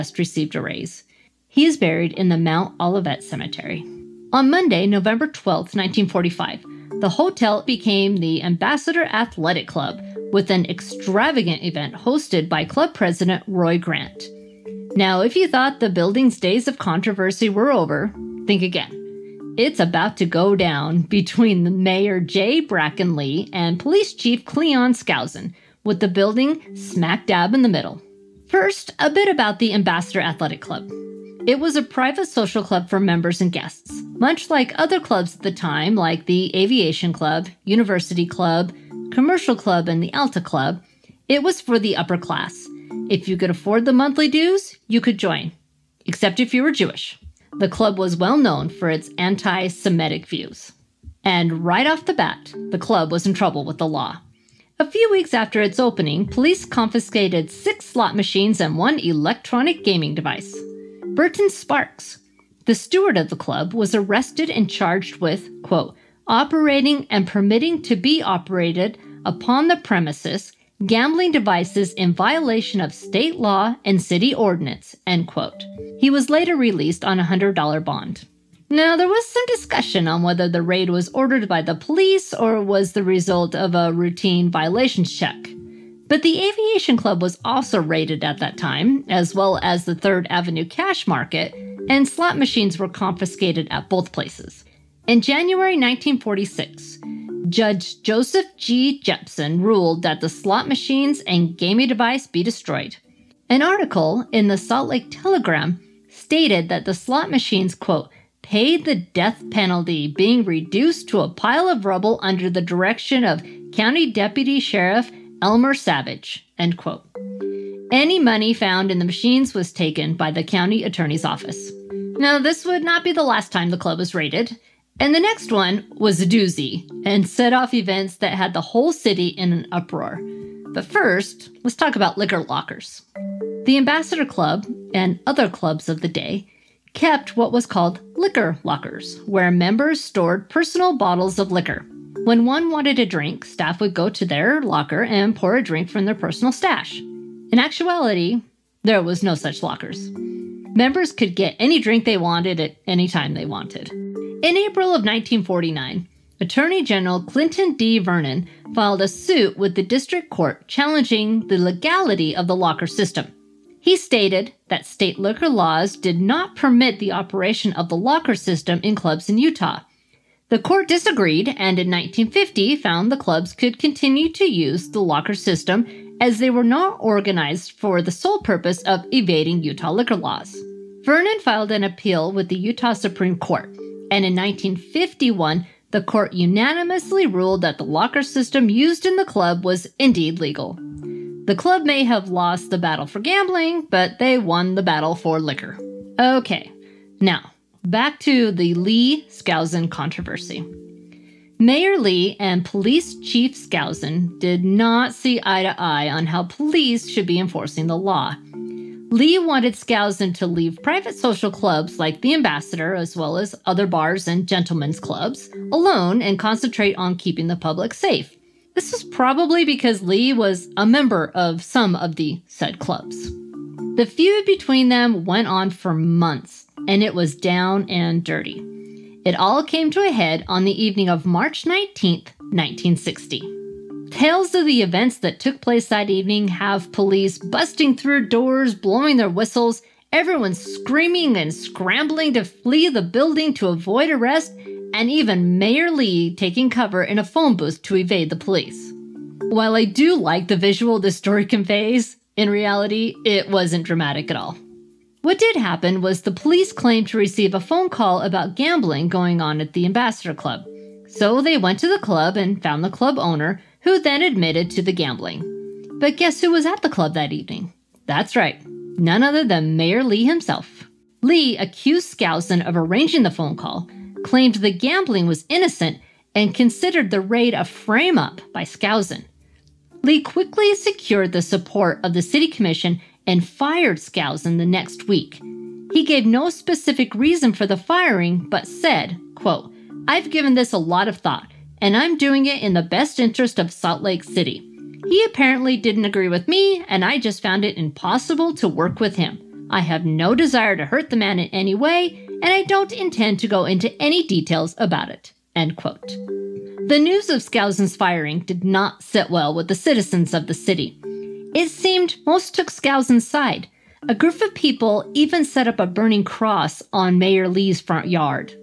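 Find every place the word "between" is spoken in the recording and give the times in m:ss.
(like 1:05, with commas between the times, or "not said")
0:21, 3:44.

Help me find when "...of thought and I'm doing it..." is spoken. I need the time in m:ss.
4:51.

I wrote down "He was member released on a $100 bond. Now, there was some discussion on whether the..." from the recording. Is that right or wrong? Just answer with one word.
wrong.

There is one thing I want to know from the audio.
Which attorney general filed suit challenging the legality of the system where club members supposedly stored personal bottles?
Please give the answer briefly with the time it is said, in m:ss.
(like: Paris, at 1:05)
Clinton D. Vernon, at 2:37.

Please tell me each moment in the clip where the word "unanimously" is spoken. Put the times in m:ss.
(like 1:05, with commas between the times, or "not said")
3:06.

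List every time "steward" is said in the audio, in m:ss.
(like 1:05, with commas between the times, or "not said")
1:02.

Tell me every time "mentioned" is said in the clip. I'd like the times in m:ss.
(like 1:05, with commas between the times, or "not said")
not said.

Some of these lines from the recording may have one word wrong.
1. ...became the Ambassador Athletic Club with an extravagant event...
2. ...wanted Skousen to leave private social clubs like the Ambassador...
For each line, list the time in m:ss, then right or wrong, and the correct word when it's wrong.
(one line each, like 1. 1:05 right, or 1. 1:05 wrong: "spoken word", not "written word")
1. 0:07 right
2. 3:29 right.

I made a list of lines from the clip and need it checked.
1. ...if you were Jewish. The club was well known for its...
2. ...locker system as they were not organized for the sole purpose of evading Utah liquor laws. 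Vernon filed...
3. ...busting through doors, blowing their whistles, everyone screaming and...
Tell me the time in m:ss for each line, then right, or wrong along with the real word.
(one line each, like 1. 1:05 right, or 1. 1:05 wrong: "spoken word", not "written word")
1. 0:46 right
2. 2:55 right
3. 3:57 right.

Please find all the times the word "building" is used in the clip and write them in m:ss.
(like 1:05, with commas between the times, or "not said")
0:15, 0:26, 4:03.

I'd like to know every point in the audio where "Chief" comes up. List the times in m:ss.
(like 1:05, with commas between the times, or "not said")
0:24, 3:23.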